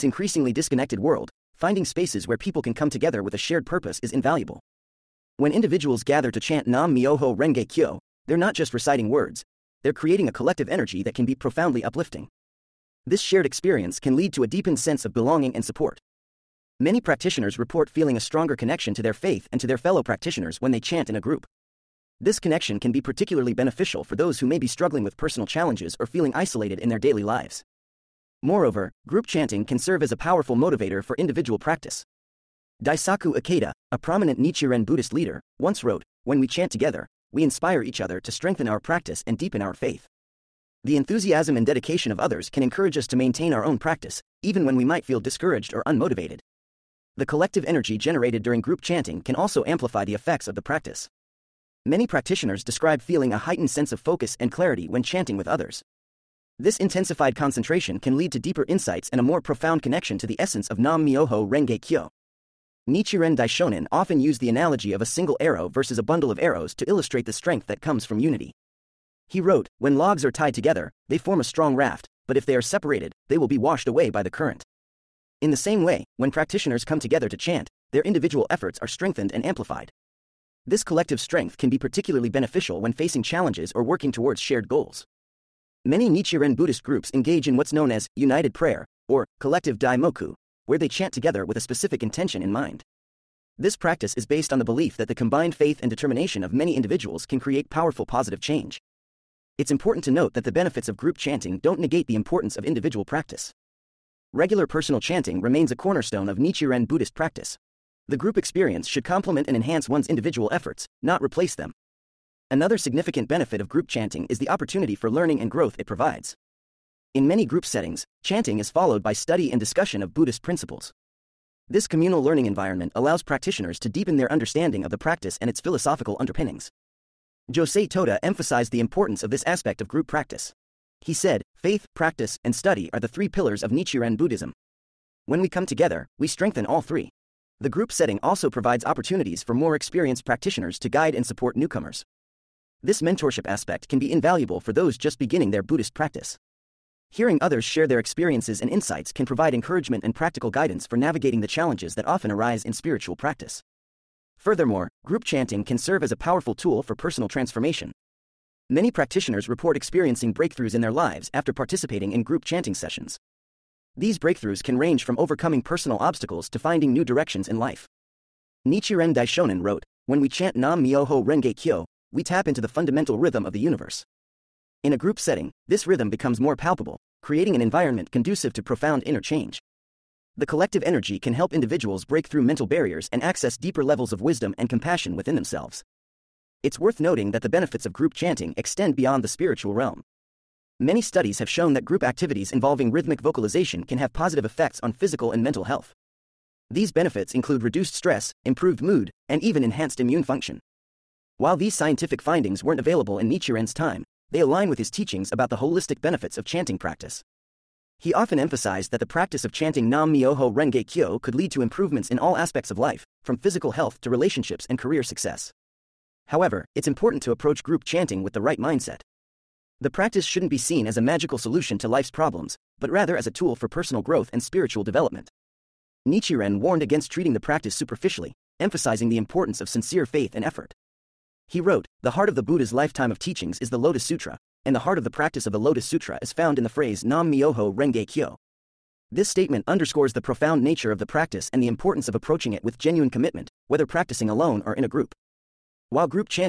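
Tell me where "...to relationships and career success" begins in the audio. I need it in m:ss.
3:34.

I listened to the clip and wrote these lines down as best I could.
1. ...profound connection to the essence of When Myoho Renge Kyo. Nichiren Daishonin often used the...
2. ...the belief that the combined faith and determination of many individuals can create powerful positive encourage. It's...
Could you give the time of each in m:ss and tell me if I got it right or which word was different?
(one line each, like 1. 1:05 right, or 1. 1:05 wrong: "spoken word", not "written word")
1. 0:59 wrong: "Nam", not "When"
2. 1:34 wrong: "change", not "encourage".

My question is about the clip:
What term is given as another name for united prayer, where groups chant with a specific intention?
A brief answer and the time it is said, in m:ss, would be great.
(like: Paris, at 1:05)
Collective daimoku, at 1:29.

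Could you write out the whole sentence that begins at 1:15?
In the same way, when practitioners come together to chant, their individual efforts are strengthened and amplified.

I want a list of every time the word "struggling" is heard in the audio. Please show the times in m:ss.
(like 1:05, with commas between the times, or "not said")
0:24.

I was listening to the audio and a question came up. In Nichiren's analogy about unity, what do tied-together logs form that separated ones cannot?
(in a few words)
A strong raft.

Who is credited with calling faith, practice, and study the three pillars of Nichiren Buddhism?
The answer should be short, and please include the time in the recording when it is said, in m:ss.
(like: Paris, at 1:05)
Josei Toda, at 2:07.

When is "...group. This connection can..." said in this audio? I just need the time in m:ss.
0:21.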